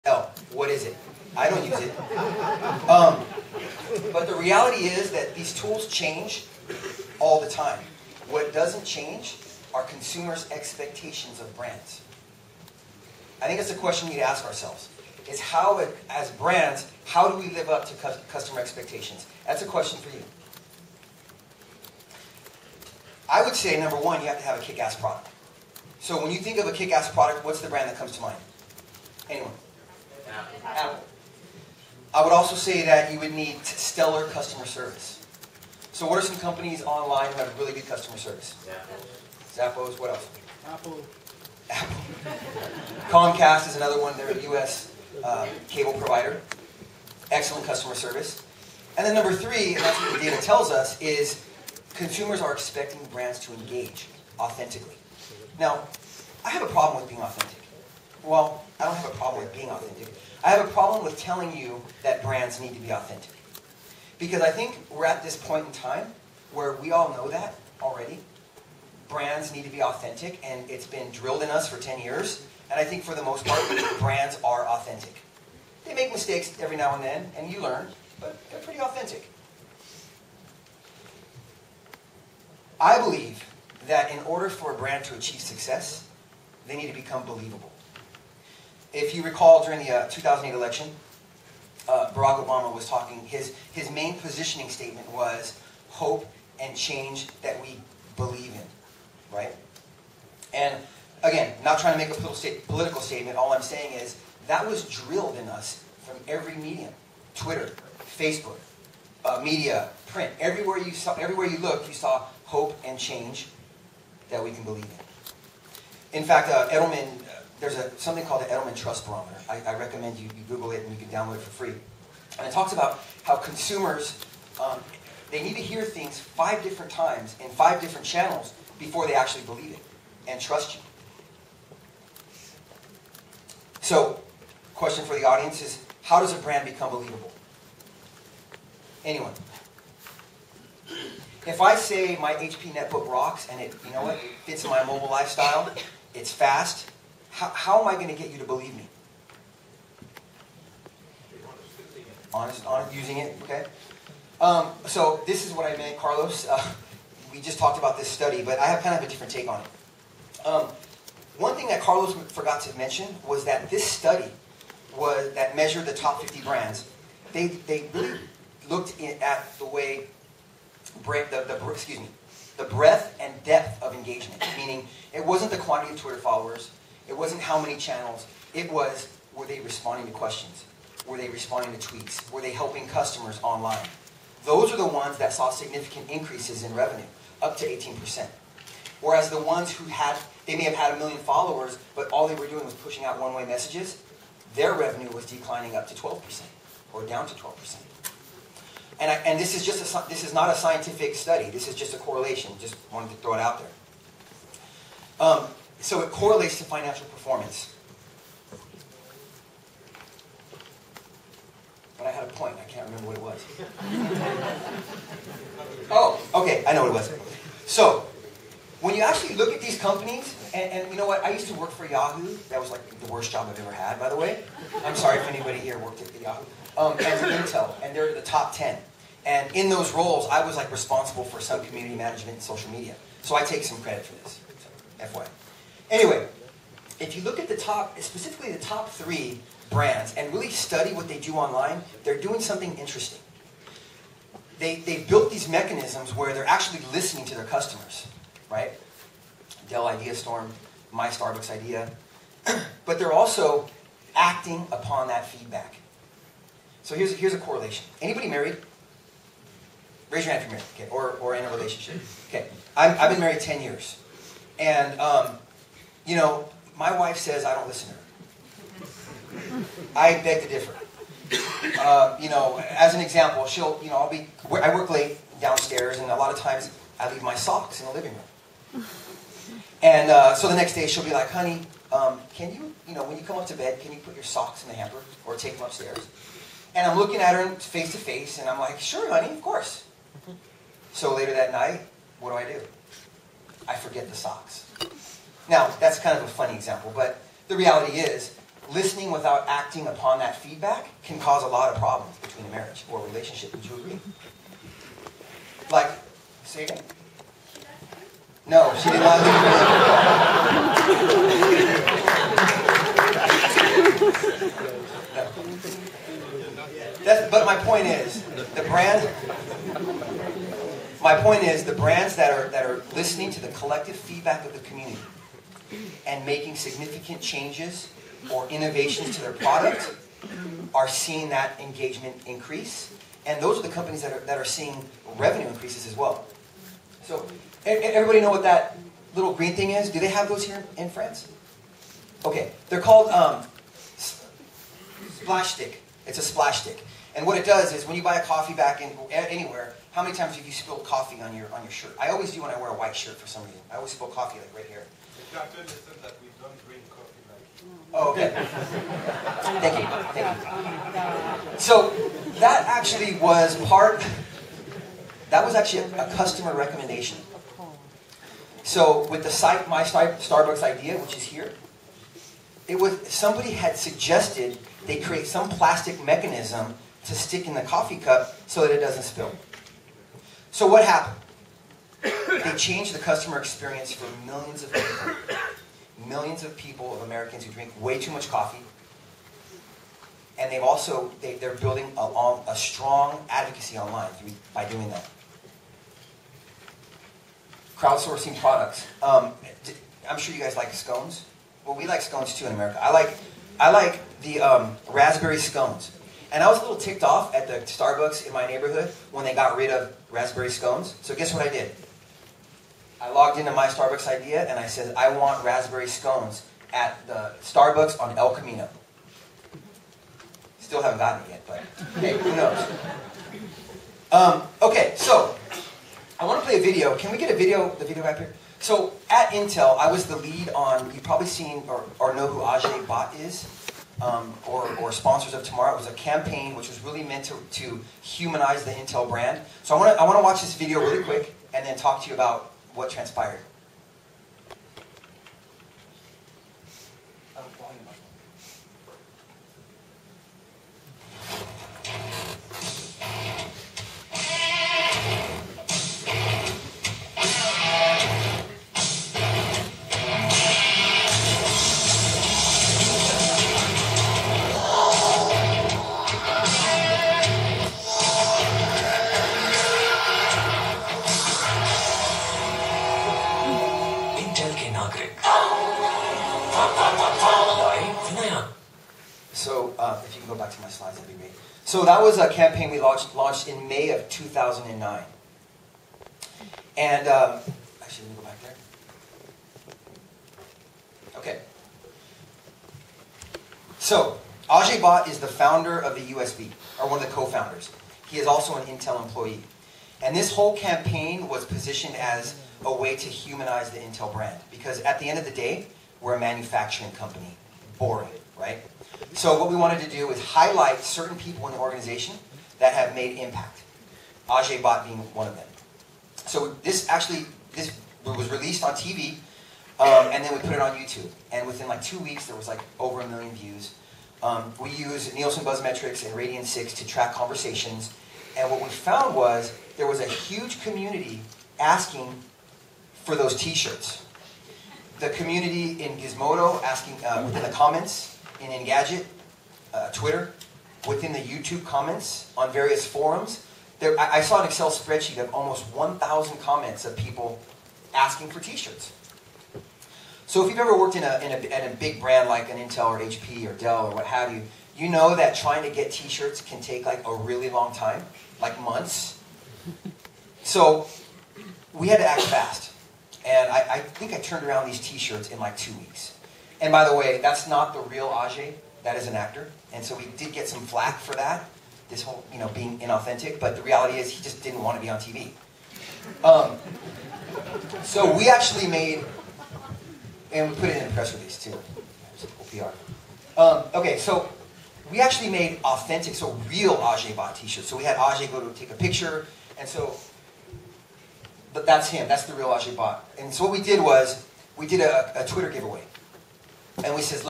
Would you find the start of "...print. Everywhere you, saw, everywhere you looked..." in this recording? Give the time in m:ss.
1:50.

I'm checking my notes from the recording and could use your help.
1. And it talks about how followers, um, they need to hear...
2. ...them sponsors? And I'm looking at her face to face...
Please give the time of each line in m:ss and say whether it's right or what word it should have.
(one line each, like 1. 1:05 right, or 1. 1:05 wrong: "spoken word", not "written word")
1. 2:02 wrong: "consumers", not "followers"
2. 4:45 wrong: "upstairs", not "sponsors".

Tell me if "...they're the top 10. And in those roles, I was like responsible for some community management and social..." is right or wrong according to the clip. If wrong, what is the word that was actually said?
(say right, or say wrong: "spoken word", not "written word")
right.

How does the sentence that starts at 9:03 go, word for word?
There, I, I saw an Excel spreadsheet of almost 1,000 comments of people asking for T-shirts.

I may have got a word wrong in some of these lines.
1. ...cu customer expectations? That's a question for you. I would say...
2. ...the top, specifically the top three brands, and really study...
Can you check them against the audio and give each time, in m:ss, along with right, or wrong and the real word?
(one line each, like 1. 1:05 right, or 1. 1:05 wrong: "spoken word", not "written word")
1. 0:17 right
2. 3:57 right.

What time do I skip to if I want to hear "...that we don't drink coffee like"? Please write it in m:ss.
5:56.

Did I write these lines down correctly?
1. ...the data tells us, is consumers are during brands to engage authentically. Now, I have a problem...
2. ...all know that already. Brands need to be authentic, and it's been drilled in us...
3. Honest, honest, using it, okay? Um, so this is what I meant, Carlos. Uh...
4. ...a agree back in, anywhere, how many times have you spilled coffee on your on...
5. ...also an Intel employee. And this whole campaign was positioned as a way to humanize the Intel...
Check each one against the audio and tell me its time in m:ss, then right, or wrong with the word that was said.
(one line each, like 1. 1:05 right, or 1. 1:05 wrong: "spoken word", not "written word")
1. 0:50 wrong: "expecting", not "during"
2. 1:06 right
3. 2:32 right
4. 5:48 wrong: "coffee", not "agree"
5. 8:18 right.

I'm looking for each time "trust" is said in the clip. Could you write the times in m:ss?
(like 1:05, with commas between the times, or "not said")
1:58, 2:10.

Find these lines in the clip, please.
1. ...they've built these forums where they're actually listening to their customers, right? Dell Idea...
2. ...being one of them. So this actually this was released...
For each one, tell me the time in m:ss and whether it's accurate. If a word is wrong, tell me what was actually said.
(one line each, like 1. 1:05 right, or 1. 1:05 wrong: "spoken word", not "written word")
1. 4:04 wrong: "mechanisms", not "forums"
2. 8:34 right.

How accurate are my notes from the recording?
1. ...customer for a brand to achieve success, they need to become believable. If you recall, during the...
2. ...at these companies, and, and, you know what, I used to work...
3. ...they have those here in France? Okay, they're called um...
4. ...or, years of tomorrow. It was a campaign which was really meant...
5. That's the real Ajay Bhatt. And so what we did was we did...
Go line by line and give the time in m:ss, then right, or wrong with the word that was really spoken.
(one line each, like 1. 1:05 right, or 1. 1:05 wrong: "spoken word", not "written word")
1. 1:24 wrong: "order", not "customer"
2. 3:39 right
3. 5:39 right
4. 7:14 wrong: "sponsors", not "years"
5. 9:52 right.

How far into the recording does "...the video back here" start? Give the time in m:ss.
7:07.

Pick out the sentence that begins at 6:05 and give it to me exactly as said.
That was actually a, a customer recommendation.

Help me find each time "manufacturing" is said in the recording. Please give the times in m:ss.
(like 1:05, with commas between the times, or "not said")
8:26.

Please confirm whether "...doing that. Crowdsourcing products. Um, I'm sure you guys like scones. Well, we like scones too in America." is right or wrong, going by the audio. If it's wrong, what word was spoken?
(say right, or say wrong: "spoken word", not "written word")
right.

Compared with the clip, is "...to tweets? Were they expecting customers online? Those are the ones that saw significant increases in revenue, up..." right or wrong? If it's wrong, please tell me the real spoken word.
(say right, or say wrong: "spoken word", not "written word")
wrong: "helping", not "expecting".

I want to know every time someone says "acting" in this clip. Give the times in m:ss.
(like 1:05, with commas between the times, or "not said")
4:14, 4:59.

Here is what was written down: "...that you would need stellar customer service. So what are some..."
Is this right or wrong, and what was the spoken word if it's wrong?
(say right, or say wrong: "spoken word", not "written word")
right.